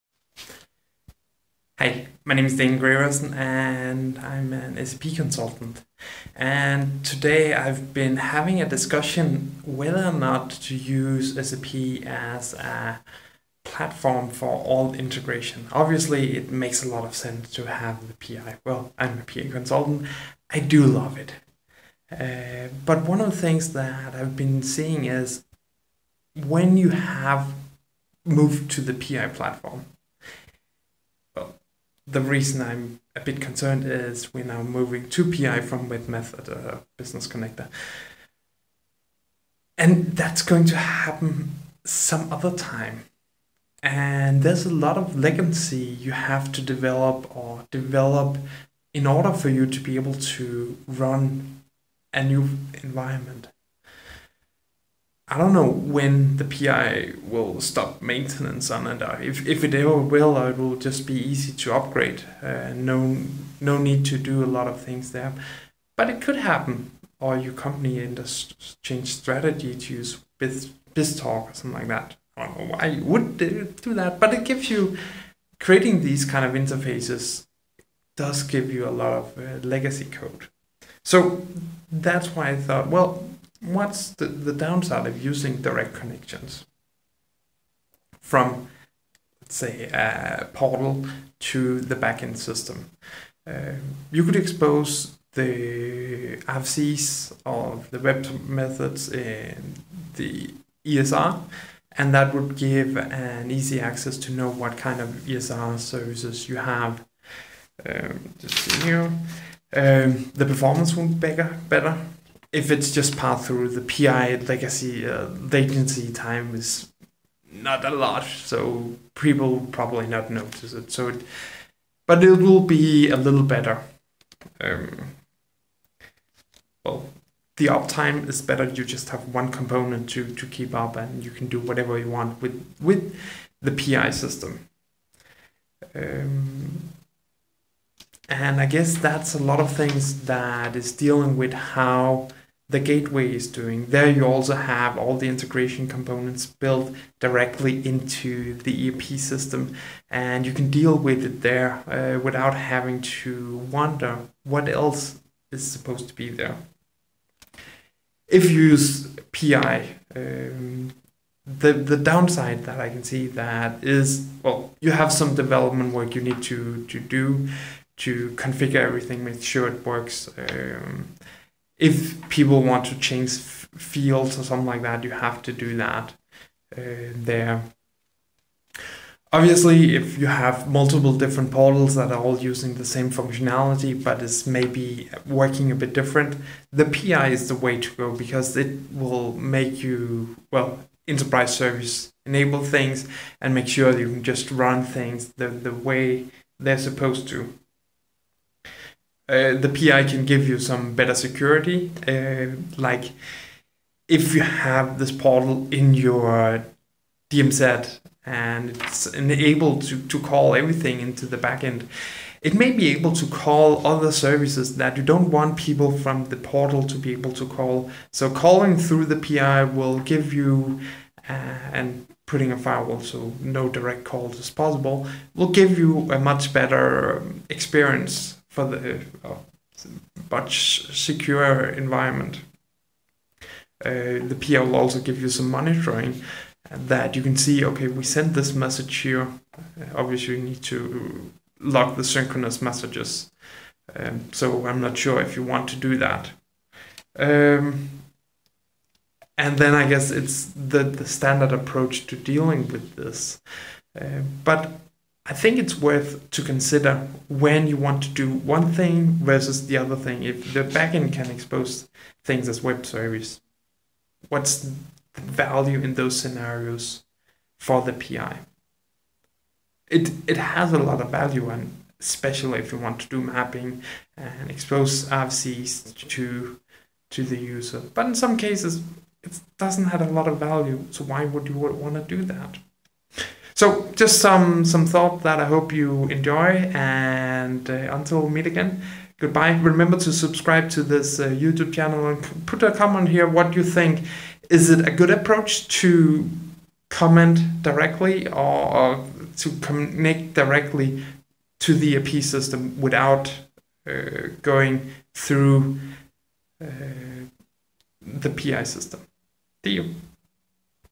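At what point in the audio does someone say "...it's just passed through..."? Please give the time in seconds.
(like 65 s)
112 s.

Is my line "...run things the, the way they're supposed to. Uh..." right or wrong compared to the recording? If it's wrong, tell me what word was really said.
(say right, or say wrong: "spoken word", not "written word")
right.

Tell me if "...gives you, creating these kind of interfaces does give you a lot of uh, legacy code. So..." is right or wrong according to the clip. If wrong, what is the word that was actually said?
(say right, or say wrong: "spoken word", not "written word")
right.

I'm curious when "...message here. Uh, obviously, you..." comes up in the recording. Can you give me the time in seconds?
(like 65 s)
238 s.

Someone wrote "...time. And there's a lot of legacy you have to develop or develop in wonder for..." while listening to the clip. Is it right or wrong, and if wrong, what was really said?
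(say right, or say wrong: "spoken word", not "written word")
wrong: "order", not "wonder".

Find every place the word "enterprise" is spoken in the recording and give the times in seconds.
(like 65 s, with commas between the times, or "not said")
191 s.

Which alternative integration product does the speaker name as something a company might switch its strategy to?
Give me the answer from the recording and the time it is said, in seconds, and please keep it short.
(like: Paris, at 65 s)
BizTalk, at 70 s.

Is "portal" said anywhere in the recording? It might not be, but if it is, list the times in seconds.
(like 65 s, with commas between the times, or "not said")
90 s, 181 s, 205 s, 216 s.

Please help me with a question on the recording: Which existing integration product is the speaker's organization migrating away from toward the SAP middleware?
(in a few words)
WebMethod.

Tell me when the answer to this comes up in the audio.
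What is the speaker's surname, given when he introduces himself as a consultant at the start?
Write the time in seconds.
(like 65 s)
2 s.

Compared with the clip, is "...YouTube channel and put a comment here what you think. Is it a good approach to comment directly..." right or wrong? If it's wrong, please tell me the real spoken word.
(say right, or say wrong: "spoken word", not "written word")
right.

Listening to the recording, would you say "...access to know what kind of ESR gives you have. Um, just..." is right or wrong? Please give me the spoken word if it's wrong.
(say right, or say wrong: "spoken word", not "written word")
wrong: "services", not "gives".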